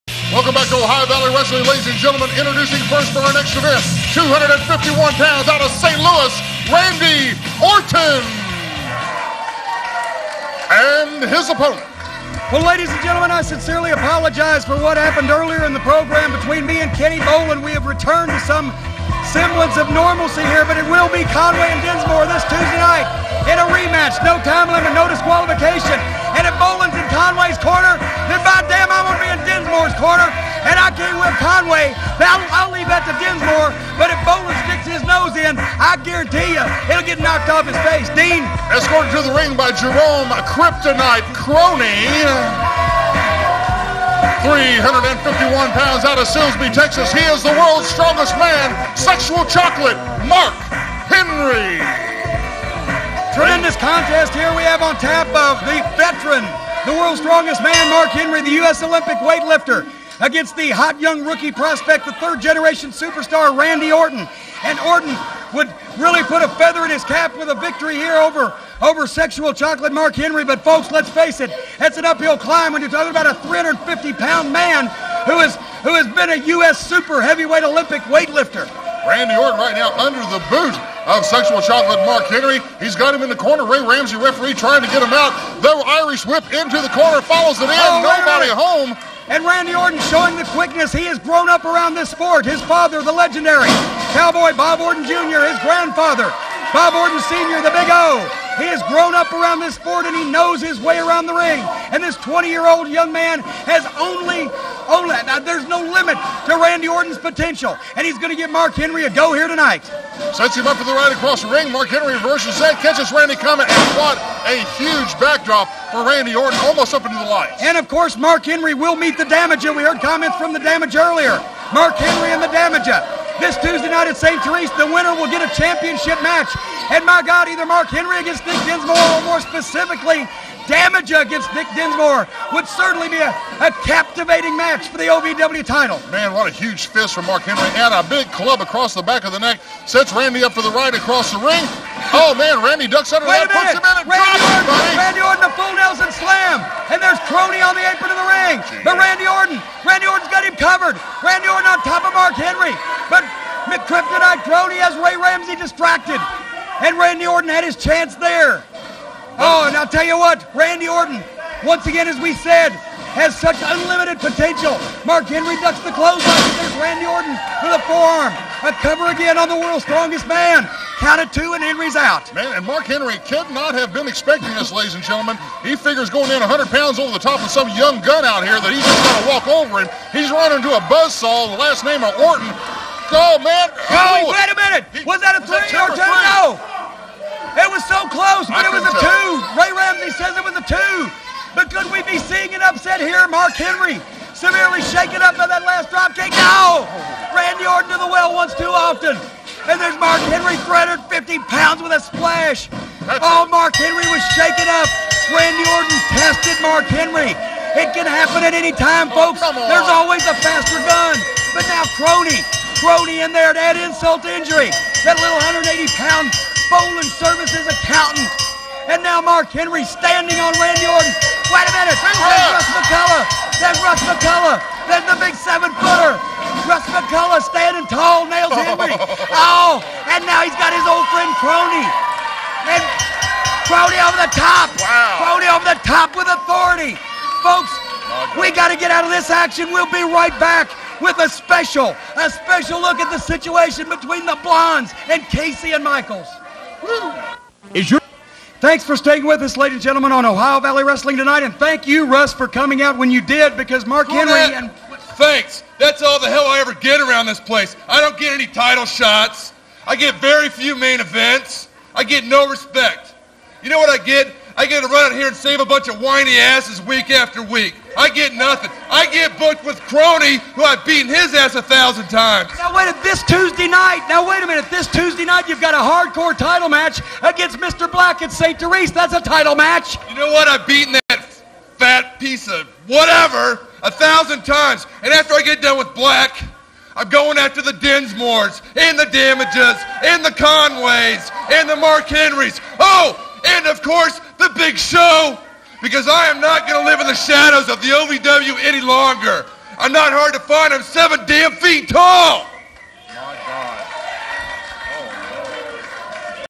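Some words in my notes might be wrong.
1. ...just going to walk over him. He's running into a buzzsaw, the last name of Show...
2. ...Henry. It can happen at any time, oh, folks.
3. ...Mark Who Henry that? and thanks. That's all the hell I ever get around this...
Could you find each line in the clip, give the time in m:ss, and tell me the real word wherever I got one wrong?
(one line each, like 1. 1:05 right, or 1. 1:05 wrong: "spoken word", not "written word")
1. 2:58 wrong: "Orton", not "Show"
2. 3:26 right
3. 4:13 right.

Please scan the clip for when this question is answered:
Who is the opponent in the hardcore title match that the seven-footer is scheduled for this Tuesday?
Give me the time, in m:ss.
4:37.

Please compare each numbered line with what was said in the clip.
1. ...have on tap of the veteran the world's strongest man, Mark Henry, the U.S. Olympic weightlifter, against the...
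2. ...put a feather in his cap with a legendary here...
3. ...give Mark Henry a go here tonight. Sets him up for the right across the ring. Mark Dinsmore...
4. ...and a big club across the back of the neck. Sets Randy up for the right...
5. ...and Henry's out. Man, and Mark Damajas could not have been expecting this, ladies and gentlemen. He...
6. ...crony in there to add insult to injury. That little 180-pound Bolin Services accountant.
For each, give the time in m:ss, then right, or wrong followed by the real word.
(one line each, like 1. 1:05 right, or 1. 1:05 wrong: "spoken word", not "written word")
1. 0:54 right
2. 1:06 wrong: "victory", not "legendary"
3. 1:48 wrong: "Henry", not "Dinsmore"
4. 2:17 right
5. 2:51 wrong: "Henry", not "Damajas"
6. 3:32 right.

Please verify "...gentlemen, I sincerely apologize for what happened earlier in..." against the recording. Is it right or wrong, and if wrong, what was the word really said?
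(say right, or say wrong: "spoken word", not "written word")
right.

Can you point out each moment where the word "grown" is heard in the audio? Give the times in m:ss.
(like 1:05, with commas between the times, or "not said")
1:31, 1:38.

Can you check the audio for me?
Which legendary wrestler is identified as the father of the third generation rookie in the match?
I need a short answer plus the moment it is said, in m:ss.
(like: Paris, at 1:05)
Cowboy Bob Orton Jr., at 1:34.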